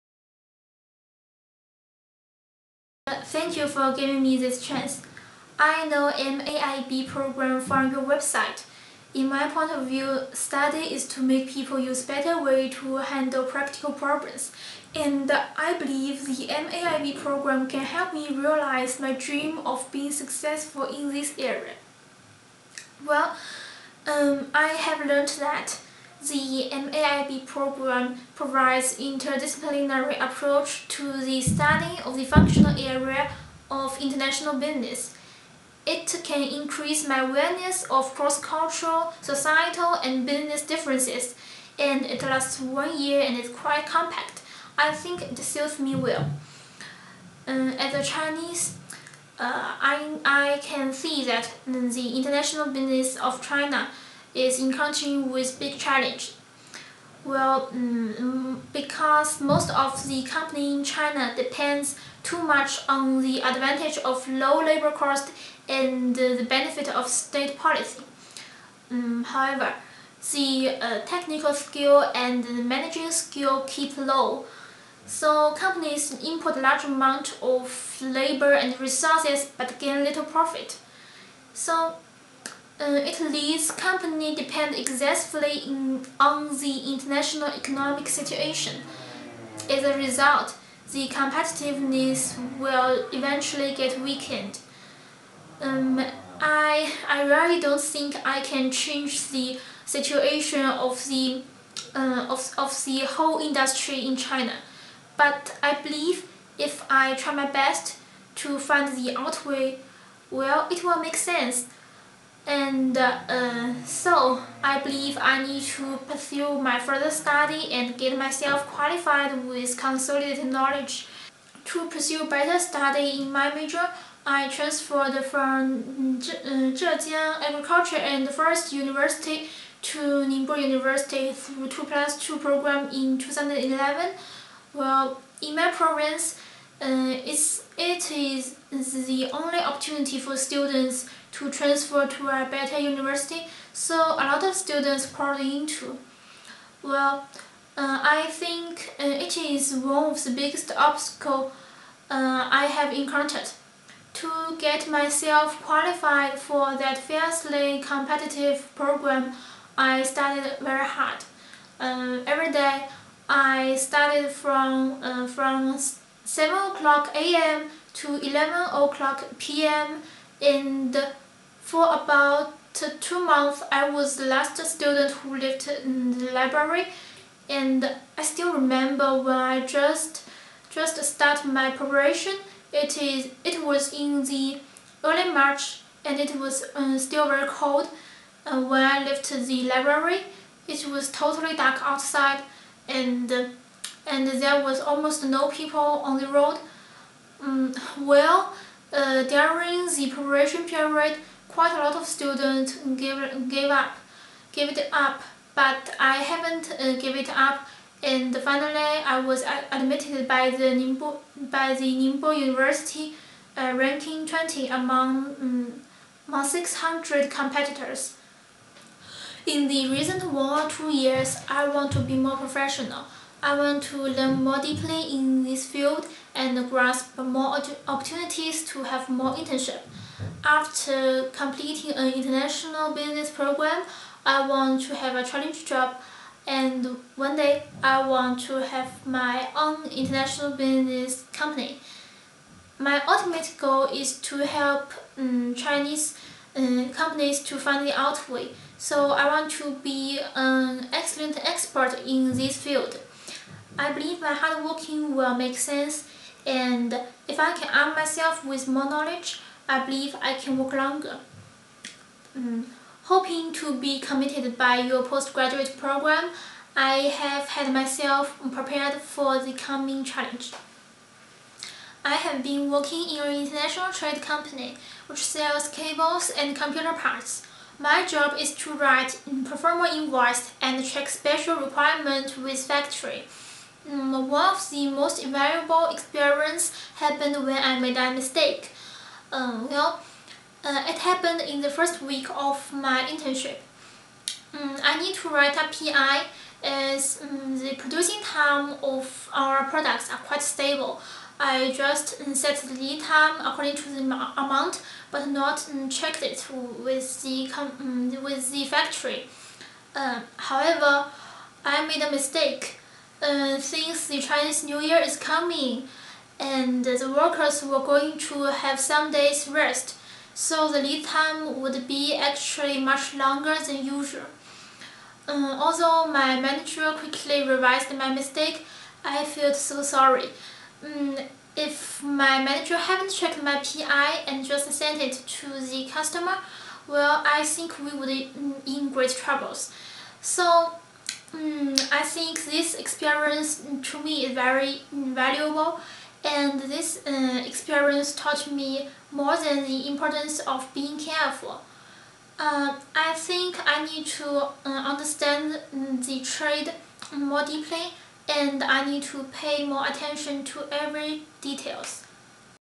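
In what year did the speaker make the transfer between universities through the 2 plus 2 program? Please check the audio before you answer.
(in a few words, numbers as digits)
2011.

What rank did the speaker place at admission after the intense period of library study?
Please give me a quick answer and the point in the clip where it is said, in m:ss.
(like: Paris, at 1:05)
20, at 3:33.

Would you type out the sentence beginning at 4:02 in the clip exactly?
My ultimate goal is to help um, Chinese uh, companies to find the out way.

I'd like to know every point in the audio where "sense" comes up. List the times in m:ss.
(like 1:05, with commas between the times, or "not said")
1:51, 4:15.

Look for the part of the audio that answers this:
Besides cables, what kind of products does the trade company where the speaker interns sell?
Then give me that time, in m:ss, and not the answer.
4:36.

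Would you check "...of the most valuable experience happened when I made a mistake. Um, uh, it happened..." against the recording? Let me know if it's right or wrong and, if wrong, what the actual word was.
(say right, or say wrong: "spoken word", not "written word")
right.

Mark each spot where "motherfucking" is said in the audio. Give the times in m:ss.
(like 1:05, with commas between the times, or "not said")
not said.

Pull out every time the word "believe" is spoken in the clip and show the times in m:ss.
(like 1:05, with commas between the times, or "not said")
0:15, 1:45, 1:54, 4:13, 4:19.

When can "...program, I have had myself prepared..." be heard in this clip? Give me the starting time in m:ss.
4:25.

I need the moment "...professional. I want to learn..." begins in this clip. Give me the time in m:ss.
3:42.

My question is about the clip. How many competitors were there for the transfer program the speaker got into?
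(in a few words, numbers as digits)
600.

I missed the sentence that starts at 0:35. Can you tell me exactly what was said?
It can increase my awareness of cross-cultural, societal, and business differences, and it lasts one year and is quite compact.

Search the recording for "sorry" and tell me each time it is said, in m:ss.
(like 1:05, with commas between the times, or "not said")
5:29.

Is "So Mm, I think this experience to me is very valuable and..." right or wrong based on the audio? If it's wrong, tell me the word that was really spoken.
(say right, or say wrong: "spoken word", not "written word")
right.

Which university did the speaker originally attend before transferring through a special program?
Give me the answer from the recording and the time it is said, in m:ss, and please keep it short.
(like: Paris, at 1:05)
Zhejiang Agriculture and Forest University, at 2:06.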